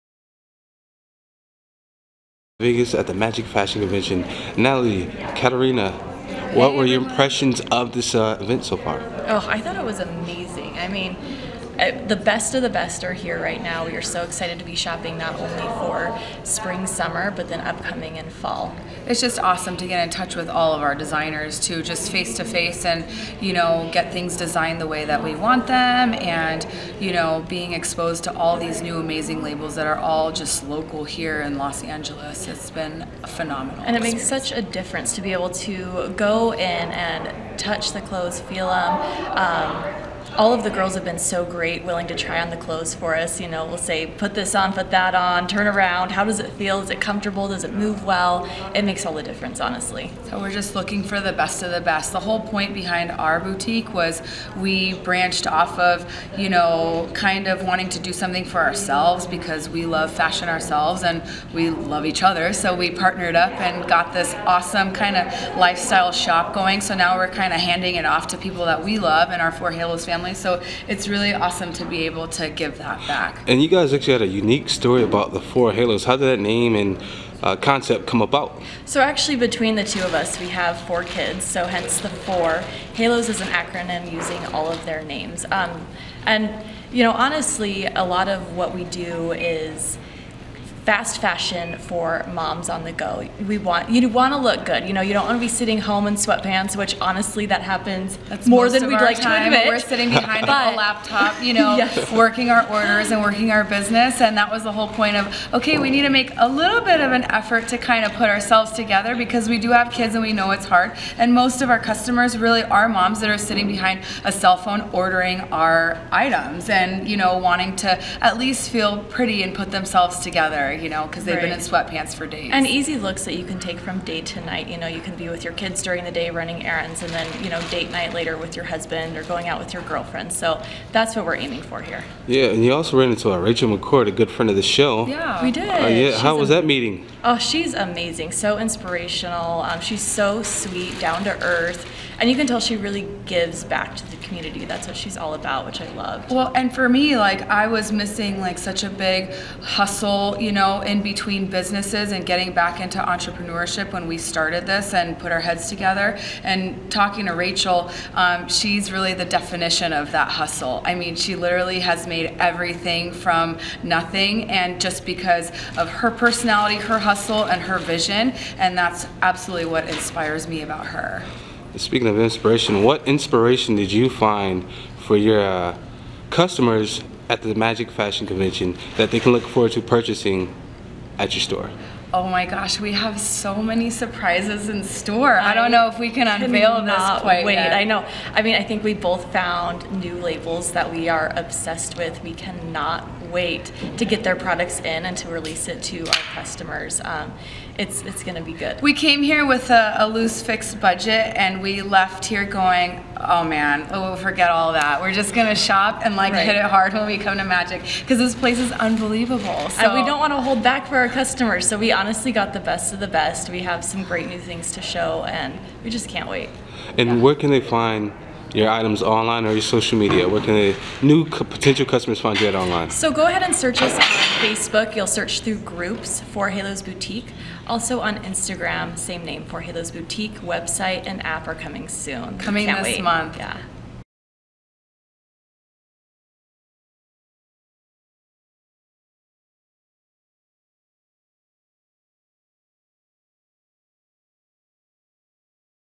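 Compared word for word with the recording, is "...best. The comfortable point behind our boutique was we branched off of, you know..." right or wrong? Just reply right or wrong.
wrong.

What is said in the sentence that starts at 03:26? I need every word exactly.
hit it hard when we come to Magic because this place is unbelievable.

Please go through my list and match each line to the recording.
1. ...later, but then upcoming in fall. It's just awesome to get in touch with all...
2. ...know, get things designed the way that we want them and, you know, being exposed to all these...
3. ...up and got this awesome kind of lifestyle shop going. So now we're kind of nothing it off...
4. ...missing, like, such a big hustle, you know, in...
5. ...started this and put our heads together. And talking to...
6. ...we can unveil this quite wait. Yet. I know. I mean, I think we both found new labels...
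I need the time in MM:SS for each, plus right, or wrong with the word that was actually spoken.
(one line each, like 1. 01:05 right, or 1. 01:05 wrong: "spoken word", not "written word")
1. 00:16 wrong: "summer", not "later"
2. 00:23 right
3. 01:03 wrong: "handing", not "nothing"
4. 02:27 right
5. 02:34 right
6. 03:05 right.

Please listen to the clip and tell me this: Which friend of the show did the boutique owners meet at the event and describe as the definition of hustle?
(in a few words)
Rachel McCord.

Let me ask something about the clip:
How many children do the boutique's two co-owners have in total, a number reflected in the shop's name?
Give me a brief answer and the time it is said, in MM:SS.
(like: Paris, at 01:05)
4, at 01:20.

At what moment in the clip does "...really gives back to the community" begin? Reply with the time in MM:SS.
02:22.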